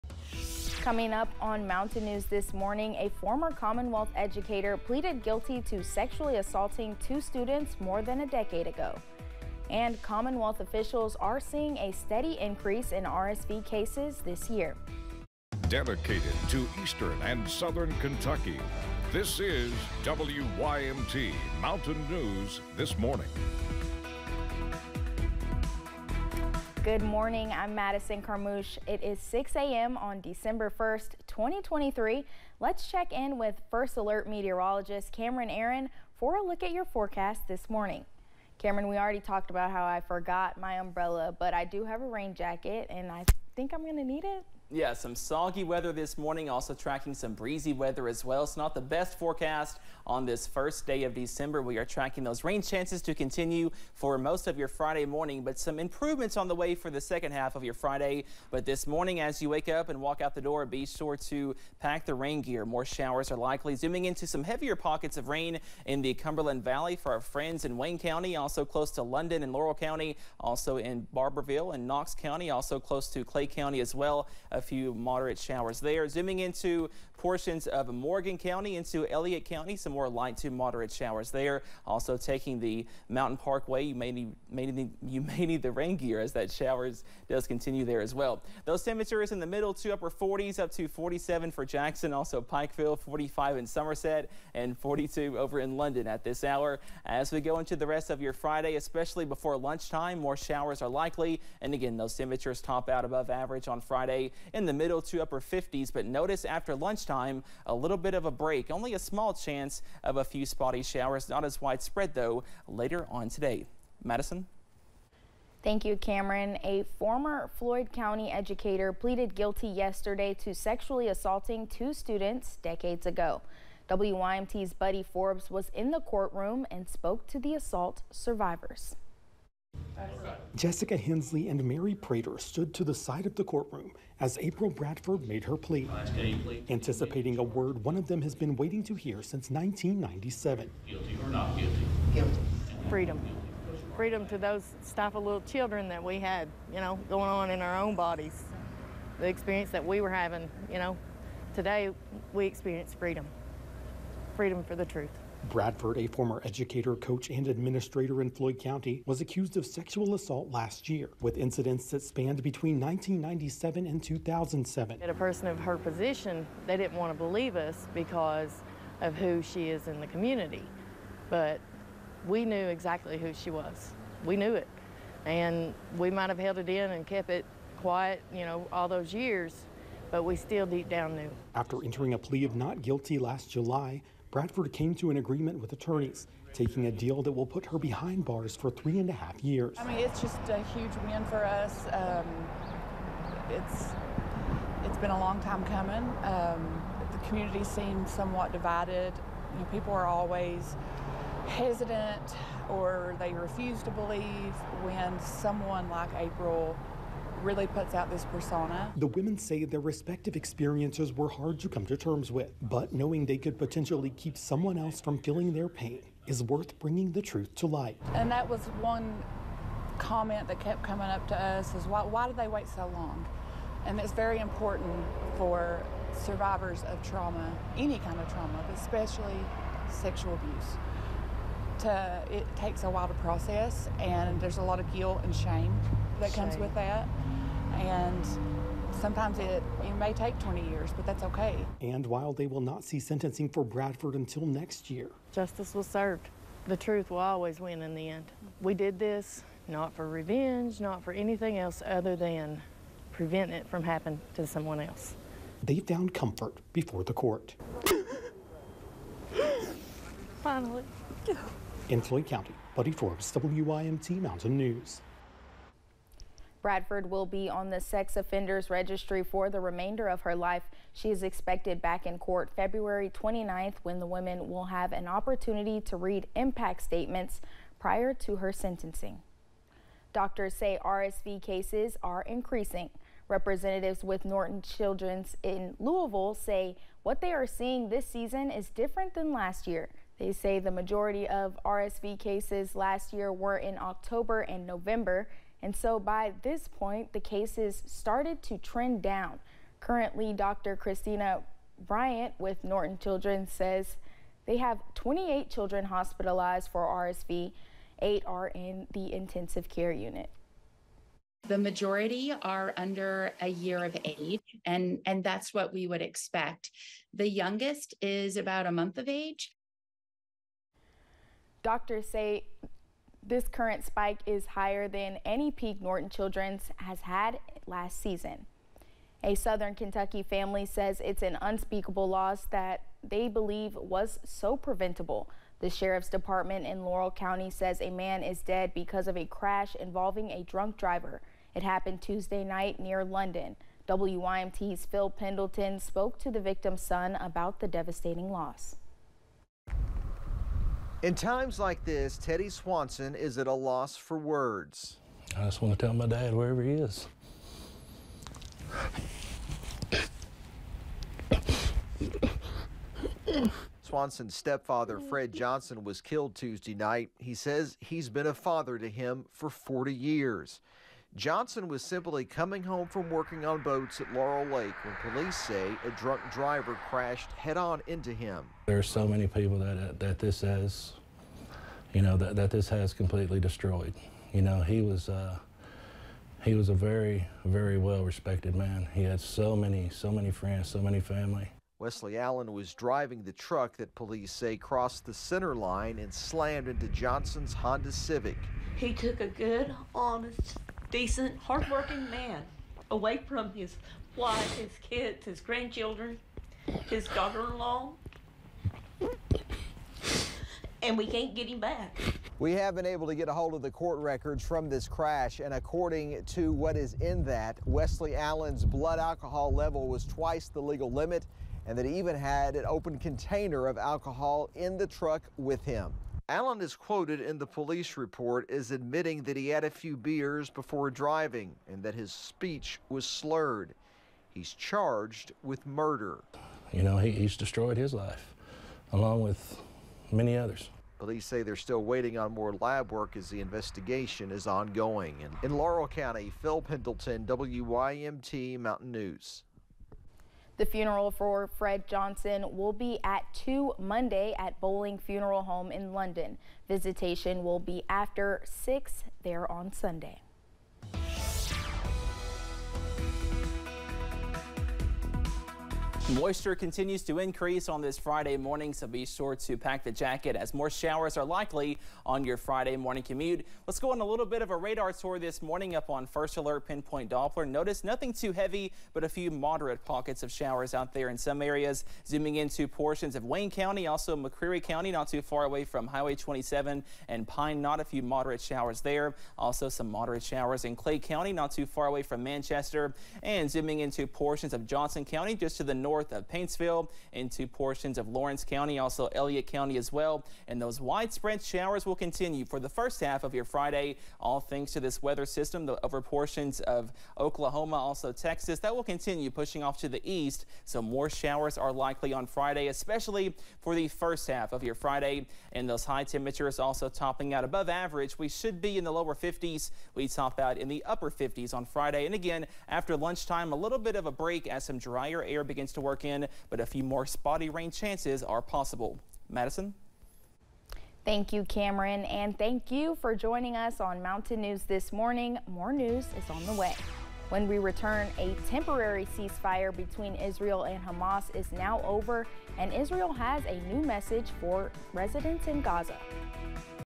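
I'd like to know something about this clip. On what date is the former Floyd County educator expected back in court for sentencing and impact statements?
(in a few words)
February 29th.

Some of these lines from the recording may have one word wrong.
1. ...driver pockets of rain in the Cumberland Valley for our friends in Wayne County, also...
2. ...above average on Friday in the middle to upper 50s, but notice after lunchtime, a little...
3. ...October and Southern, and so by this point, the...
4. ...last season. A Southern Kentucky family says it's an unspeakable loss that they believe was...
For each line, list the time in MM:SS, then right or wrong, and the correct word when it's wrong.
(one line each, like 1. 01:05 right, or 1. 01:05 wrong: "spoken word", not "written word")
1. 01:04 wrong: "heavier", not "driver"
2. 01:43 right
3. 04:53 wrong: "November", not "Southern"
4. 05:27 right.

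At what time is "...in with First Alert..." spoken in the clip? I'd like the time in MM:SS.
00:33.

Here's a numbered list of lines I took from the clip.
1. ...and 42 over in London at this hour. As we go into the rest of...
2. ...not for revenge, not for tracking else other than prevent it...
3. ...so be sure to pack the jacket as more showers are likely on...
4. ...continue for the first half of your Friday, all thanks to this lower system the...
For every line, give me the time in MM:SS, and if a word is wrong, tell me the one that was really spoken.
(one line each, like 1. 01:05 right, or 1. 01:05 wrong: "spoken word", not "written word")
1. 01:34 right
2. 04:09 wrong: "anything", not "tracking"
3. 07:48 right
4. 08:21 wrong: "weather", not "lower".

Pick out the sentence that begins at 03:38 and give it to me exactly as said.
And that was one comment that kept coming up to us is why, why did they wait so long?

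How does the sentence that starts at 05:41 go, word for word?
It happened Tuesday night near London.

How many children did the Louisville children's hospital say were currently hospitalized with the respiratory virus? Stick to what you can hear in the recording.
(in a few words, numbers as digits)
28.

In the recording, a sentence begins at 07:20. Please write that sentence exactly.
Police say they're still waiting on more lab work as the investigation is ongoing.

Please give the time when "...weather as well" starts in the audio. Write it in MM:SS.
00:47.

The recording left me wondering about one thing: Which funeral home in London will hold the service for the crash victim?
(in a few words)
Bowling Funeral Home.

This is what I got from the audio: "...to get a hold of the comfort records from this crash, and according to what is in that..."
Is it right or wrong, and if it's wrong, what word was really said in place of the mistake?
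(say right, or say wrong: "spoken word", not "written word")
wrong: "court", not "comfort".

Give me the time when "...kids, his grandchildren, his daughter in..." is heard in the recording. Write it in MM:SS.
06:44.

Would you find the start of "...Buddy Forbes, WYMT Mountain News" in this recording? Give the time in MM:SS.
04:22.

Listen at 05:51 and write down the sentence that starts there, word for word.
In times like this, Teddy Swanson is at a loss for words.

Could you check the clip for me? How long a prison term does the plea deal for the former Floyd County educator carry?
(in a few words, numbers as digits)
Three and a half years.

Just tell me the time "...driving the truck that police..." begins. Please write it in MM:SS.
06:32.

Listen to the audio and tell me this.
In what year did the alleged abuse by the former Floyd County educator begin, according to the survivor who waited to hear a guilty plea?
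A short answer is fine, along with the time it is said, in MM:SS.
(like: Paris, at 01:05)
1997, at 02:19.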